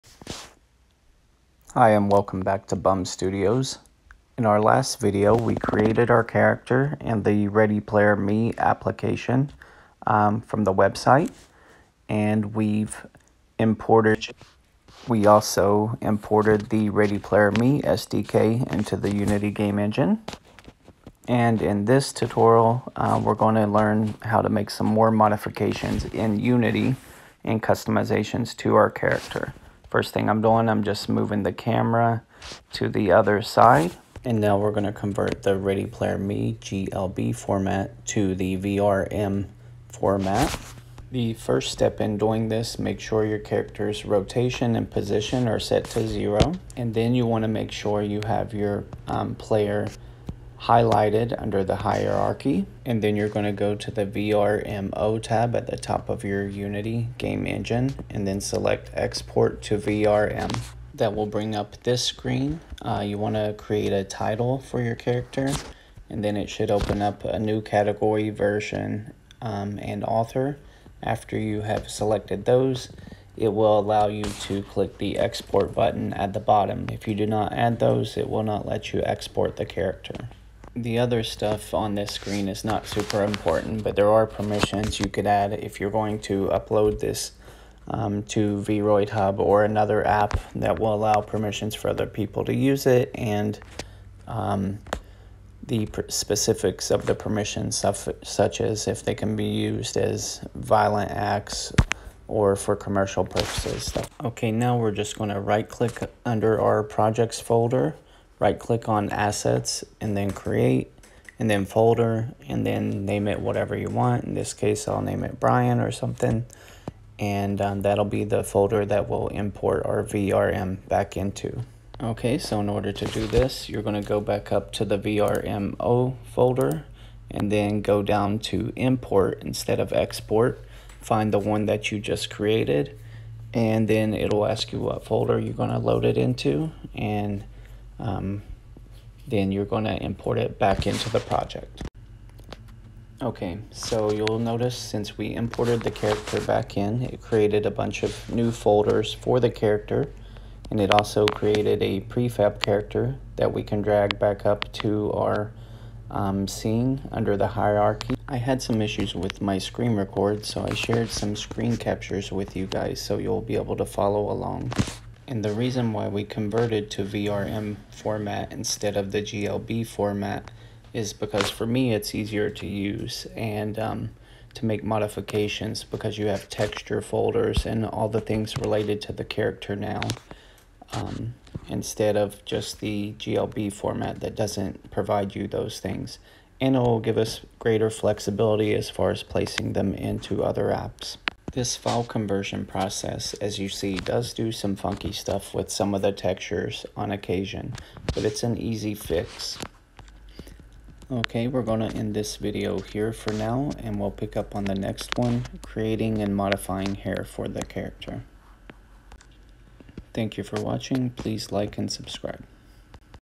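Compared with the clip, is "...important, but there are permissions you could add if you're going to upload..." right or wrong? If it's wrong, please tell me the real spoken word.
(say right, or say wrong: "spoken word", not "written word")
right.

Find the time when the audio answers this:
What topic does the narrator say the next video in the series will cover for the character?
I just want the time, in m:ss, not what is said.
3:25.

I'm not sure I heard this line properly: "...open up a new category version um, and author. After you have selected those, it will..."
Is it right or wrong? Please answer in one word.
right.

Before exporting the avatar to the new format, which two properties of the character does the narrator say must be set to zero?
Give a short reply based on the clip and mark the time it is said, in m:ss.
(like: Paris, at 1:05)
rotation and position, at 0:44.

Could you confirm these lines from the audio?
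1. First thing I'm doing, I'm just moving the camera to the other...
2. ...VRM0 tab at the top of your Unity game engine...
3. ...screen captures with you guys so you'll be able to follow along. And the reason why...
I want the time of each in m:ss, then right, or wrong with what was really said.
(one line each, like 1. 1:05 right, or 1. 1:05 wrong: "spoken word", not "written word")
1. 0:29 right
2. 0:54 right
3. 2:41 right.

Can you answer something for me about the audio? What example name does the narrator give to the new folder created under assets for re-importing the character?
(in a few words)
Brian.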